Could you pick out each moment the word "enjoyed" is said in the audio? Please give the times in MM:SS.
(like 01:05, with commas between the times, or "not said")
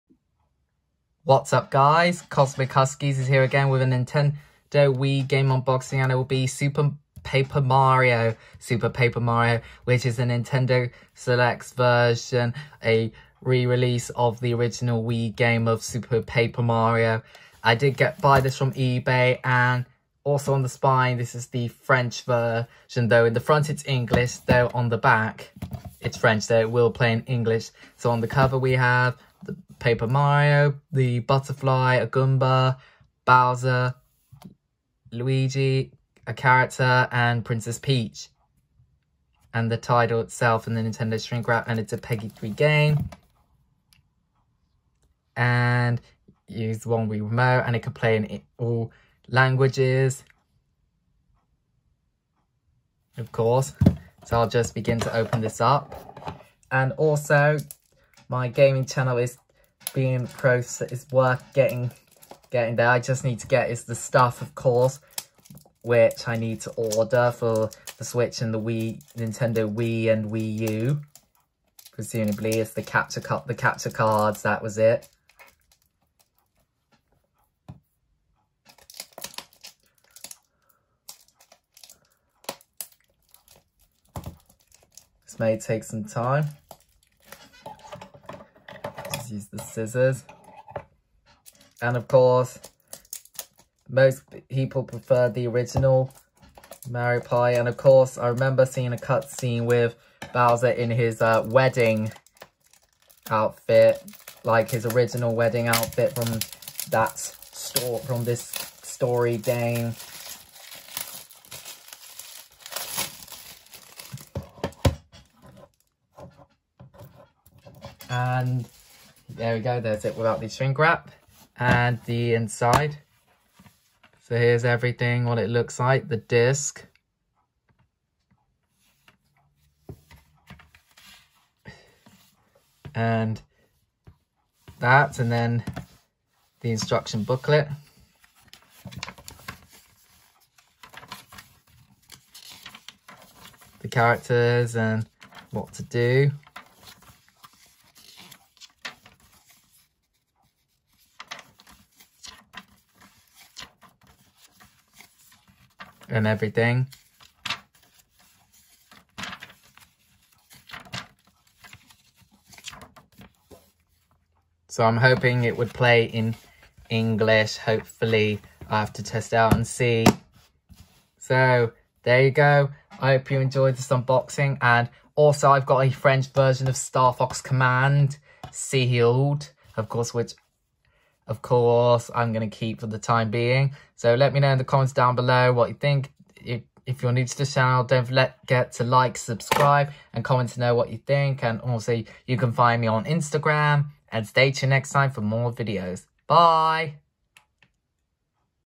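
02:53.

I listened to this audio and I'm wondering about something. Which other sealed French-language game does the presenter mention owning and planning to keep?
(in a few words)
Star Fox Command.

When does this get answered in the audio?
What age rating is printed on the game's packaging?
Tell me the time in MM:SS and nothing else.
00:41.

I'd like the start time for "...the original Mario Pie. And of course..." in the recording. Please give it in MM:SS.
01:35.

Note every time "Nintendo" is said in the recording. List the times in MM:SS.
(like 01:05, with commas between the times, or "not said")
00:03, 00:10, 00:40, 01:09.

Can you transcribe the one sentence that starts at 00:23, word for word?
In the front it's English though on the back it's French though it will play in English.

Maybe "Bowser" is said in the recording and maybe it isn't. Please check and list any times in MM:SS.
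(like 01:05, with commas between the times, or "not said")
00:33, 01:40.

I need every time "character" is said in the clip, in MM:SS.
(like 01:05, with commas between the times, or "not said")
00:36, 02:23.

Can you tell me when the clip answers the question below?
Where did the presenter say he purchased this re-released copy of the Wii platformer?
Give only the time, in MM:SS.
00:18.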